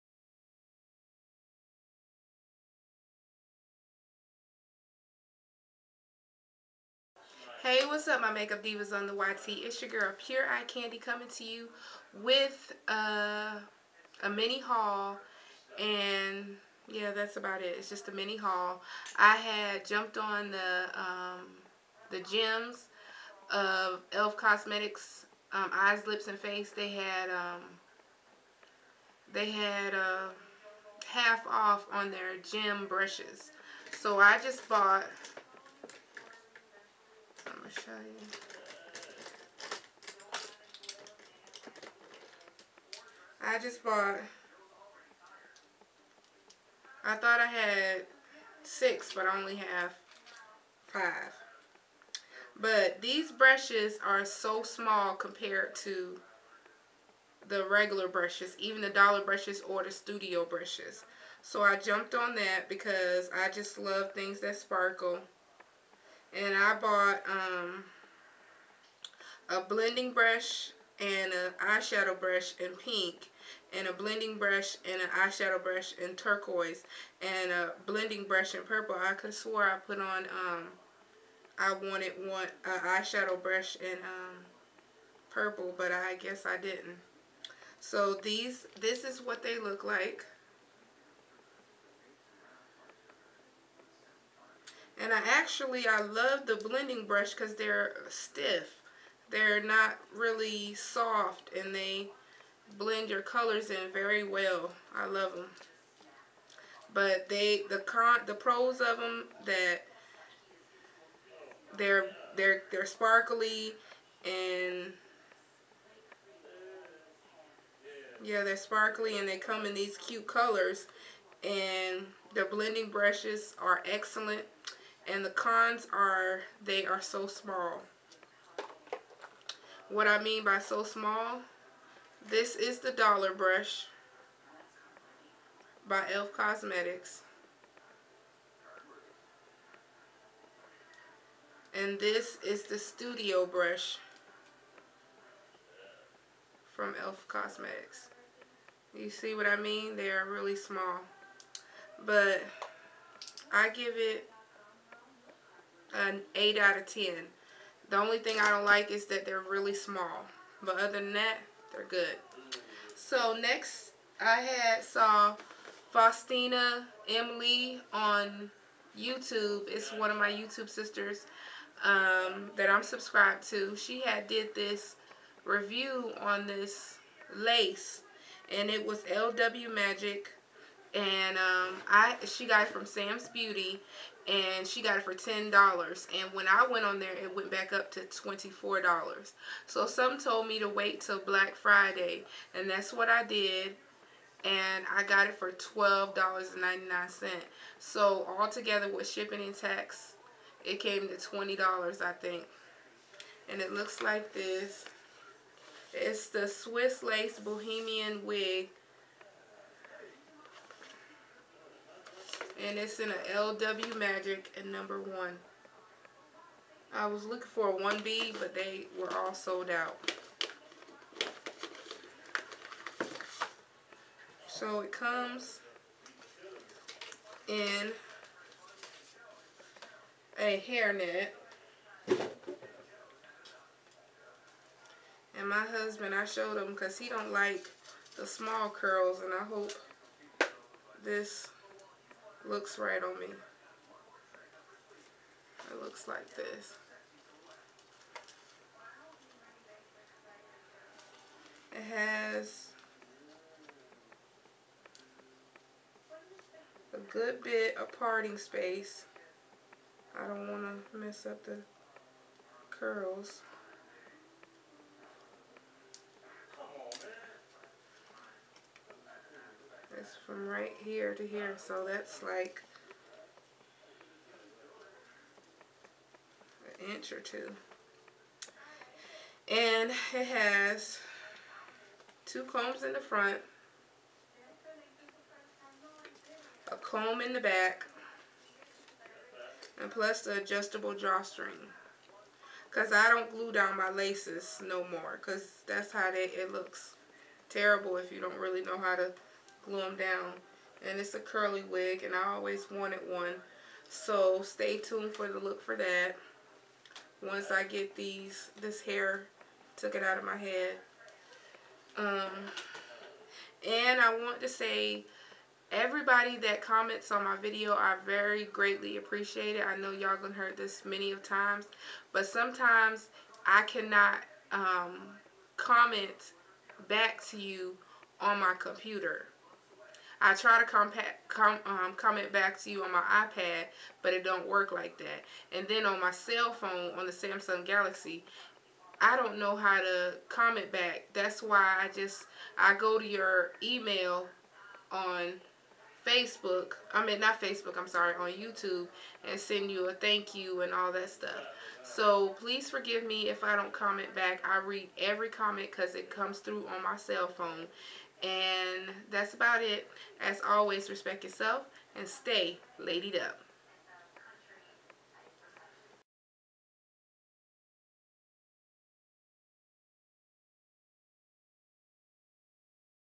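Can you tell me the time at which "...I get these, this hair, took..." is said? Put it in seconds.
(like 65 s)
307 s.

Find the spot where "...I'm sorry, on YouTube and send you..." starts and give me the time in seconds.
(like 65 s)
347 s.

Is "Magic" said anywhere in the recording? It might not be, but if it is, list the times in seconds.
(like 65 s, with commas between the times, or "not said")
179 s, 213 s.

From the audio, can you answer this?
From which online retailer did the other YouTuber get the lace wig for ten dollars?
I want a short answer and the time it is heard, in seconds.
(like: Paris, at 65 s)
Sam's Beauty, at 182 s.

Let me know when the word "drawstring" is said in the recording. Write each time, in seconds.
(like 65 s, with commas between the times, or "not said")
290 s.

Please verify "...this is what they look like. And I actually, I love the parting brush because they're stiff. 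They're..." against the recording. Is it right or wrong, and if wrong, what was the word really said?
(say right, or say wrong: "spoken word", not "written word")
wrong: "blending", not "parting".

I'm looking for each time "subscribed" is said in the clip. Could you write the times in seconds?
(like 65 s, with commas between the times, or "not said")
172 s.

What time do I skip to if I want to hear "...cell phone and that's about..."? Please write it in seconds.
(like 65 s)
356 s.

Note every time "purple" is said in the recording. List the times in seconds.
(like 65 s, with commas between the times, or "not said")
78 s, 85 s.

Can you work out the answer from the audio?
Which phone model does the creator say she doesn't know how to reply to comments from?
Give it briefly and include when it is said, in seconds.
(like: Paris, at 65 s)
Samsung Galaxy, at 337 s.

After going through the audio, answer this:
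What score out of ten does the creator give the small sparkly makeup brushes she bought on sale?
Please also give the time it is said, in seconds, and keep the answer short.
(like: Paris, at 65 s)
8, at 156 s.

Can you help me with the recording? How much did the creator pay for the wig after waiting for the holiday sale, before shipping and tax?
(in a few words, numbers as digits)
$12.99.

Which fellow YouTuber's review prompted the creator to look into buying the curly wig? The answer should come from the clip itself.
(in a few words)
Faustina Emily.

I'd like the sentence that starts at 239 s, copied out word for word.
And I hope this looks right on me.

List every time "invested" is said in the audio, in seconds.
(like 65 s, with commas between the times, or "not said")
not said.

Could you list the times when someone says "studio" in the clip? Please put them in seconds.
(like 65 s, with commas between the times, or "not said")
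59 s, 142 s.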